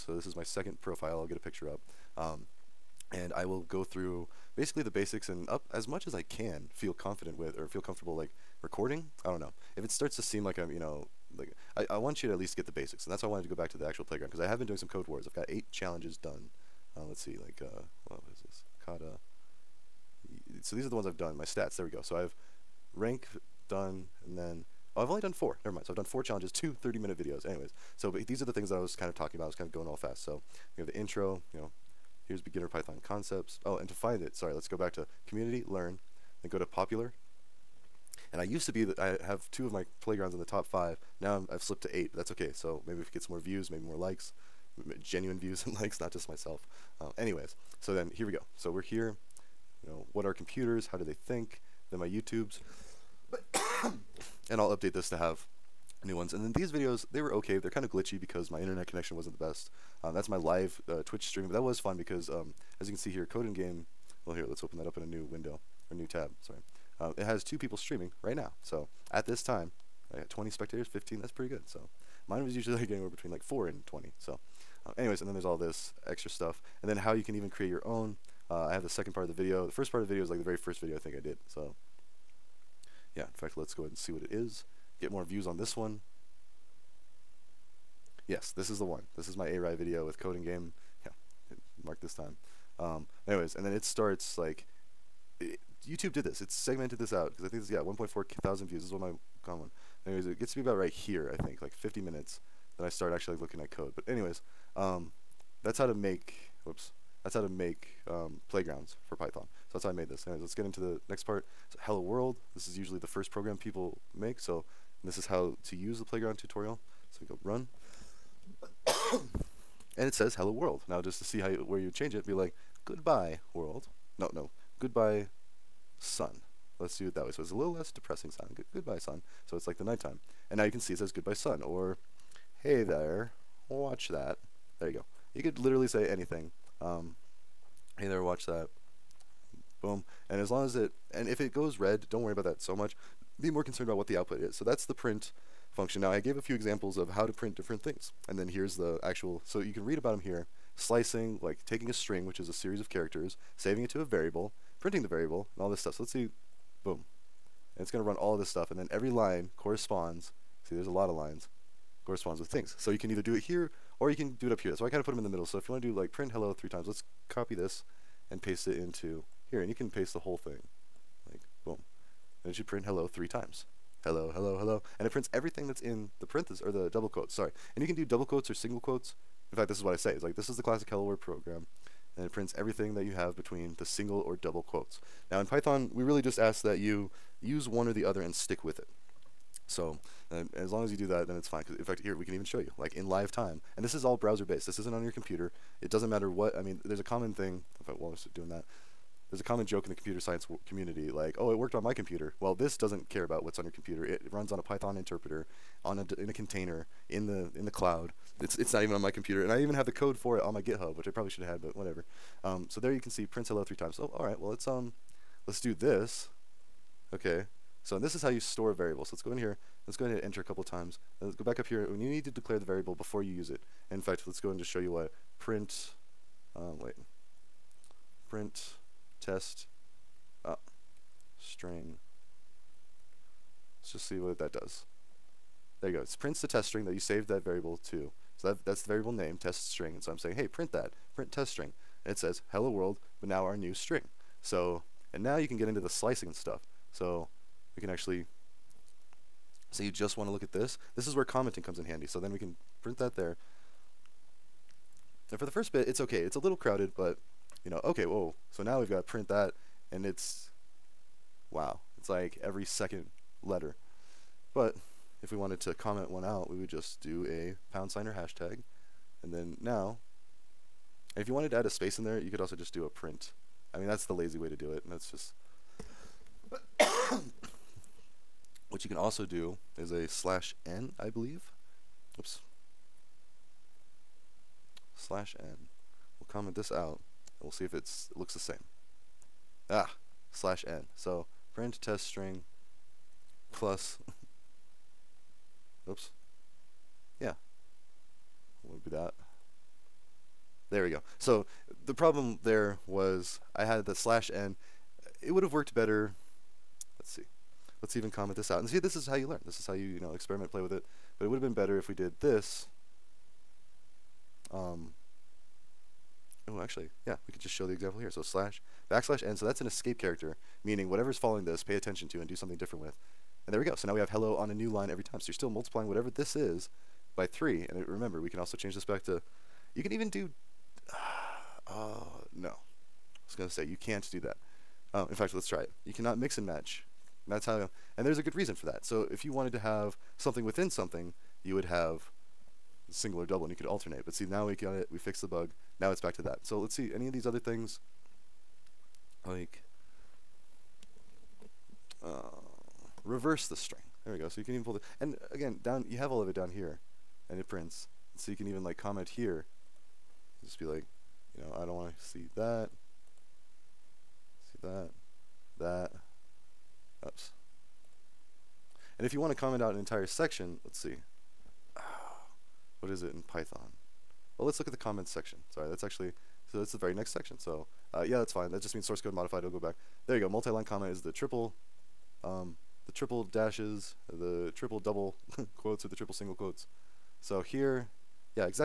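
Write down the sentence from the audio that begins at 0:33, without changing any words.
Oh, and to find it, sorry, let's go back to community, learn, then go to popular.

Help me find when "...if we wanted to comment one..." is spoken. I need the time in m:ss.
4:25.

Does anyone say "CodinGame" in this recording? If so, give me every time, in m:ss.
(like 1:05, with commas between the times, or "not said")
1:03, 1:30.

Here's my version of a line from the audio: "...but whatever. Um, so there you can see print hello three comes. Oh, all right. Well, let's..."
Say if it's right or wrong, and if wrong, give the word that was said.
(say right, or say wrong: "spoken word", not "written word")
wrong: "times", not "comes".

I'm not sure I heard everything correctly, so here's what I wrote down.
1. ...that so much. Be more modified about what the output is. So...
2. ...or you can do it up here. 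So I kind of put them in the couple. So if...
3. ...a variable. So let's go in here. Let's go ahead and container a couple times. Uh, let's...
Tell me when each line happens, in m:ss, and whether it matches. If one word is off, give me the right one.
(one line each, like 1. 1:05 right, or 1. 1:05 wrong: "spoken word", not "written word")
1. 2:22 wrong: "concerned", not "modified"
2. 2:44 wrong: "middle", not "couple"
3. 3:38 wrong: "enter", not "container".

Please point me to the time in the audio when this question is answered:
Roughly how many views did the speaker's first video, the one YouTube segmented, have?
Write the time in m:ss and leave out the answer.
1:37.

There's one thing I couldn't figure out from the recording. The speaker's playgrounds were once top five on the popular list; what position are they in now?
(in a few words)
8.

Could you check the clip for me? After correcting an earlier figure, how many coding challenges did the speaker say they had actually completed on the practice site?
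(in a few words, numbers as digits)
4.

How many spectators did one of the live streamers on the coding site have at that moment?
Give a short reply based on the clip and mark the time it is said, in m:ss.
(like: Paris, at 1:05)
20, at 1:10.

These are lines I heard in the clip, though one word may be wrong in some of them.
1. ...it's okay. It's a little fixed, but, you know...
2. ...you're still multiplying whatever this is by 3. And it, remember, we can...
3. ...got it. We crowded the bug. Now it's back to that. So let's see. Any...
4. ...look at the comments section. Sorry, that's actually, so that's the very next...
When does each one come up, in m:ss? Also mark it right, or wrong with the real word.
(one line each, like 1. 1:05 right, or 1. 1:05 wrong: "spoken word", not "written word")
1. 4:15 wrong: "crowded", not "fixed"
2. 5:25 right
3. 5:44 wrong: "fixed", not "crowded"
4. 6:14 right.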